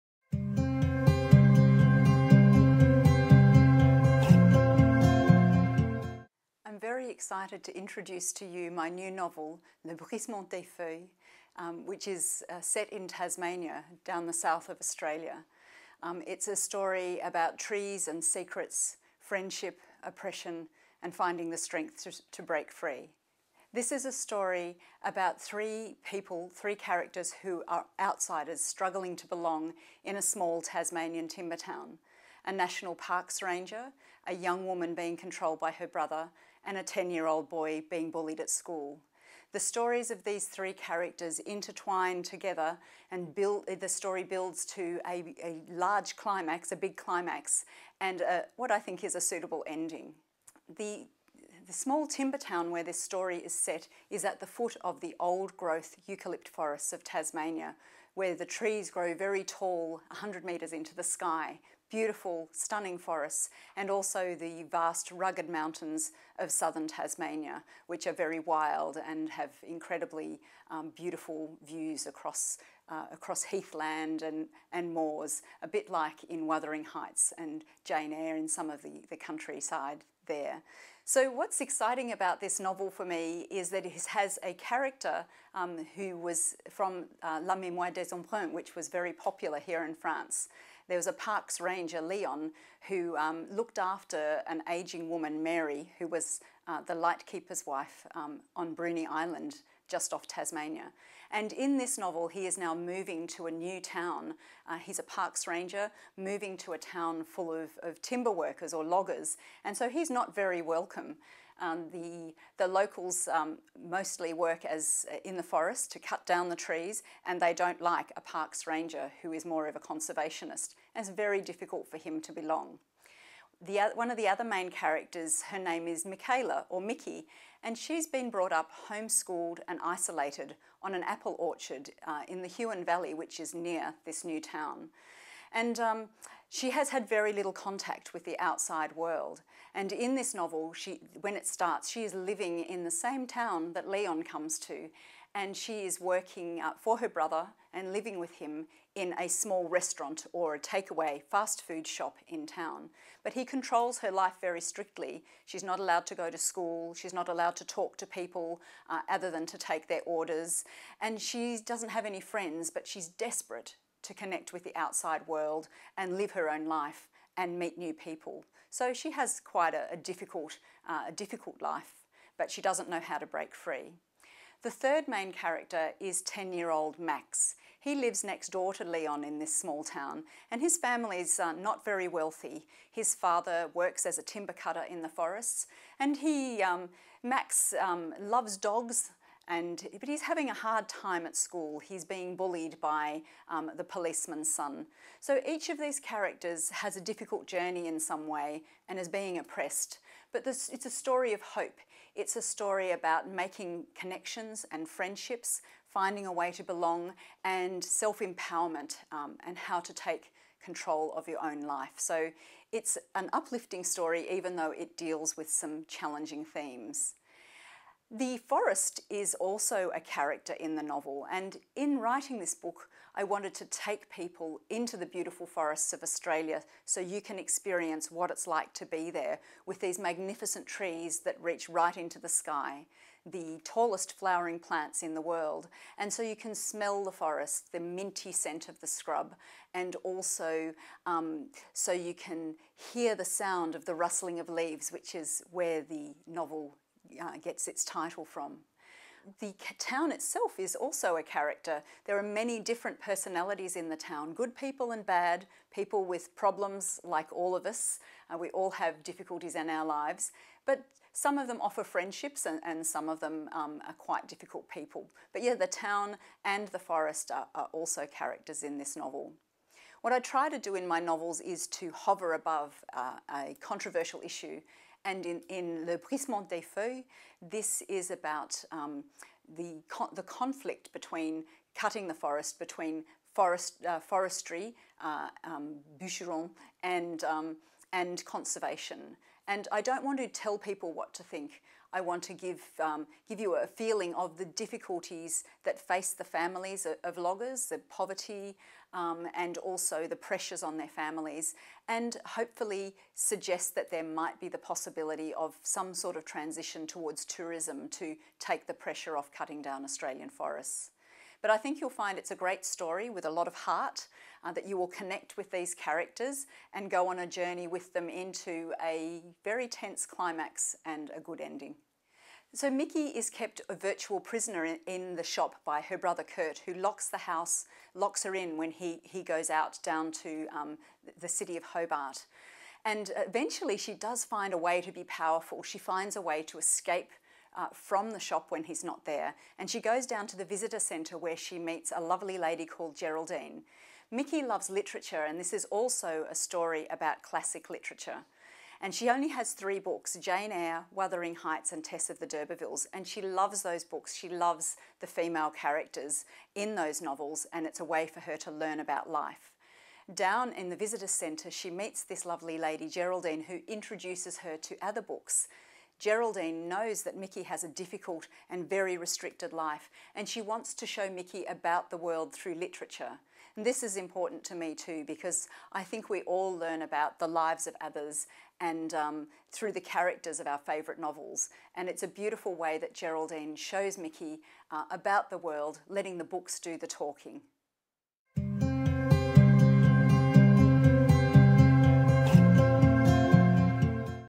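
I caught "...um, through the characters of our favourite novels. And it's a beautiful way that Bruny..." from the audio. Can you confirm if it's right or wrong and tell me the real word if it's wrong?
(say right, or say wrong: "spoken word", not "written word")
wrong: "Geraldine", not "Bruny".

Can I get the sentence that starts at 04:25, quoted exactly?
But yeah, the town and the forest are, are also characters in this novel.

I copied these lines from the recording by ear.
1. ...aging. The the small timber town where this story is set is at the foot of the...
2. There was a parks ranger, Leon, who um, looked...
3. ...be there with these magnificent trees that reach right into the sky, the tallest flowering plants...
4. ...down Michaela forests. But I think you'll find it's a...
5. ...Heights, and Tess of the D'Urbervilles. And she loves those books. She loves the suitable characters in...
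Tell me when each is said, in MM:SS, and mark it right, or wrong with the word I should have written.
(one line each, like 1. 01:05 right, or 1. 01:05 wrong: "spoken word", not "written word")
1. 00:49 wrong: "ending", not "aging"
2. 01:30 right
3. 03:48 right
4. 05:09 wrong: "Australian", not "Michaela"
5. 05:51 wrong: "female", not "suitable".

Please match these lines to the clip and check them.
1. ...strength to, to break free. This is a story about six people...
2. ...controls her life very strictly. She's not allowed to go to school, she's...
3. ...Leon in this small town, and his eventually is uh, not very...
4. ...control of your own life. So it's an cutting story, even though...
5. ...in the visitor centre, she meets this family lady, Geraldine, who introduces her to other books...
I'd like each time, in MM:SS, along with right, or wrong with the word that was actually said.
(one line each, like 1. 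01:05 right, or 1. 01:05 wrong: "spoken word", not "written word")
1. 00:21 wrong: "three", not "six"
2. 02:33 right
3. 02:58 wrong: "family", not "eventually"
4. 03:30 wrong: "uplifting", not "cutting"
5. 06:00 wrong: "lovely", not "family".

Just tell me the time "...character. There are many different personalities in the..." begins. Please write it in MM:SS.
04:11.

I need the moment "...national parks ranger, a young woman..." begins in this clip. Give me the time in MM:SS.
00:32.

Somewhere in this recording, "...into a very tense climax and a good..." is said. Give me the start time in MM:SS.
05:18.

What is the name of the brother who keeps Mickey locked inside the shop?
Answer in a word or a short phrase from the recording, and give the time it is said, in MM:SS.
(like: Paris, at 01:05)
Kurt, at 05:26.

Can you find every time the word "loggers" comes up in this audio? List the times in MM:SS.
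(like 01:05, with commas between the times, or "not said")
01:48, 04:57.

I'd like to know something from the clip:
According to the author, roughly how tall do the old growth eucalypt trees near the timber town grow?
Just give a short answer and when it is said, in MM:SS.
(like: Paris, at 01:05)
100 metres, at 01:00.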